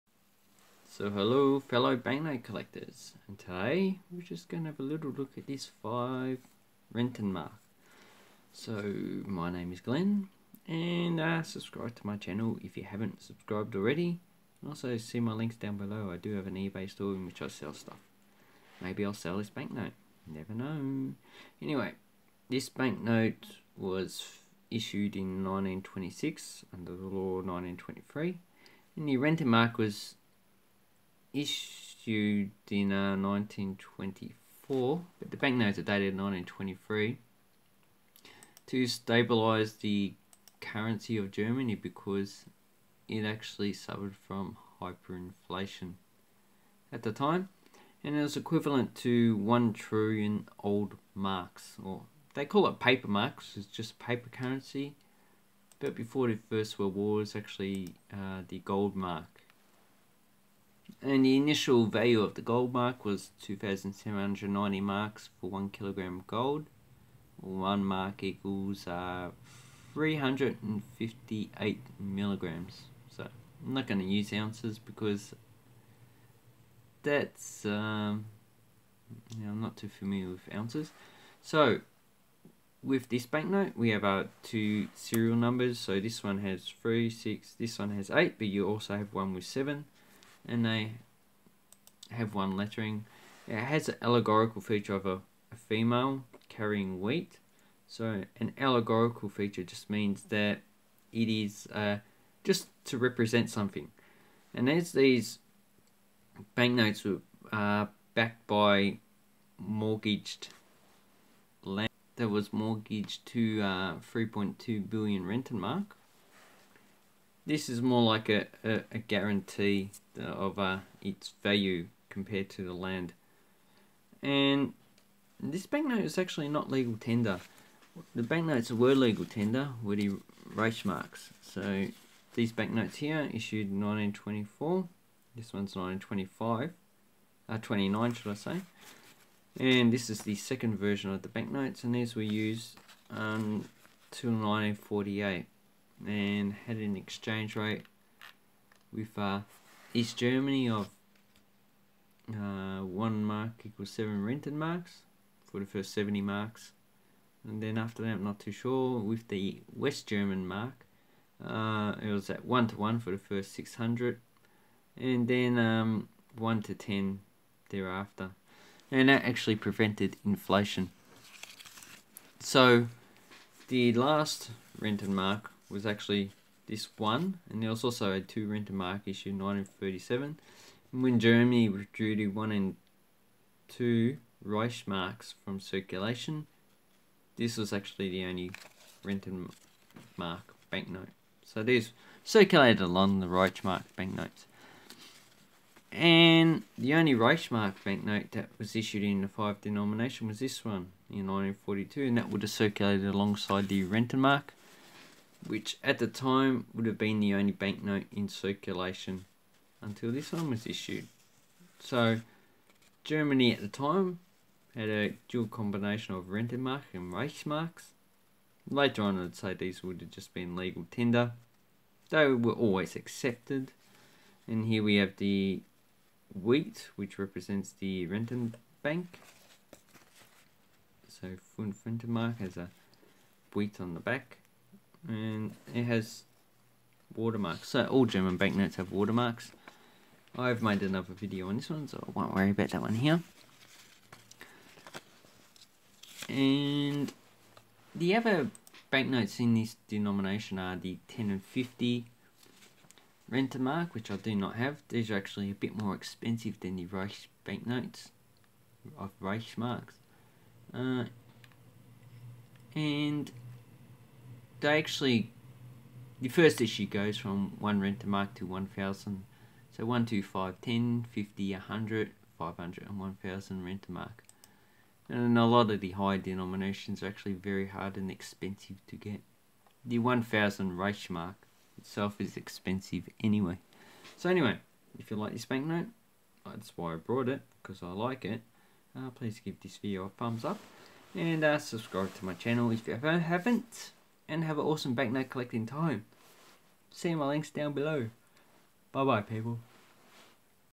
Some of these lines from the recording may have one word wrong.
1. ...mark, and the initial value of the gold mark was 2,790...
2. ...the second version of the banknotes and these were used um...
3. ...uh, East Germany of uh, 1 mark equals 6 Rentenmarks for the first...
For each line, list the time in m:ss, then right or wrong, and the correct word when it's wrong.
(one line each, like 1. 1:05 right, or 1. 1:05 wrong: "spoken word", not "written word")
1. 0:58 right
2. 2:20 right
3. 2:29 wrong: "7", not "6".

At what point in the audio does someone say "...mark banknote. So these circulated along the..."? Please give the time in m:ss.
3:10.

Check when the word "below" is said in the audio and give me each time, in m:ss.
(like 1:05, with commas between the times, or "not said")
0:15, 4:57.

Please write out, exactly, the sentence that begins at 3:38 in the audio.
Later on, I'd say these would have just been legal tender.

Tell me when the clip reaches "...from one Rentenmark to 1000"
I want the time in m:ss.
4:27.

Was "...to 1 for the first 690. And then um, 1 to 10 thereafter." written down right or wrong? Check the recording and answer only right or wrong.
wrong.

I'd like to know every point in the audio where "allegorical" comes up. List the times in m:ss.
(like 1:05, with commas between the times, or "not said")
1:34, 1:38.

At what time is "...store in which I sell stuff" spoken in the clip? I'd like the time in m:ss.
0:16.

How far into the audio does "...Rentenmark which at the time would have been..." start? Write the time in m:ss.
3:23.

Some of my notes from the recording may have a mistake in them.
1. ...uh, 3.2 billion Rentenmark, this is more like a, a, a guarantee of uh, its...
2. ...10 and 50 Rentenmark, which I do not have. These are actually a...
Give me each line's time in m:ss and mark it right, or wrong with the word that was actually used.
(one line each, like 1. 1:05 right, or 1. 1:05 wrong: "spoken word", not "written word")
1. 1:53 right
2. 4:11 right.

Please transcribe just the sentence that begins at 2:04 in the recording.
And this banknote is actually not legal tender.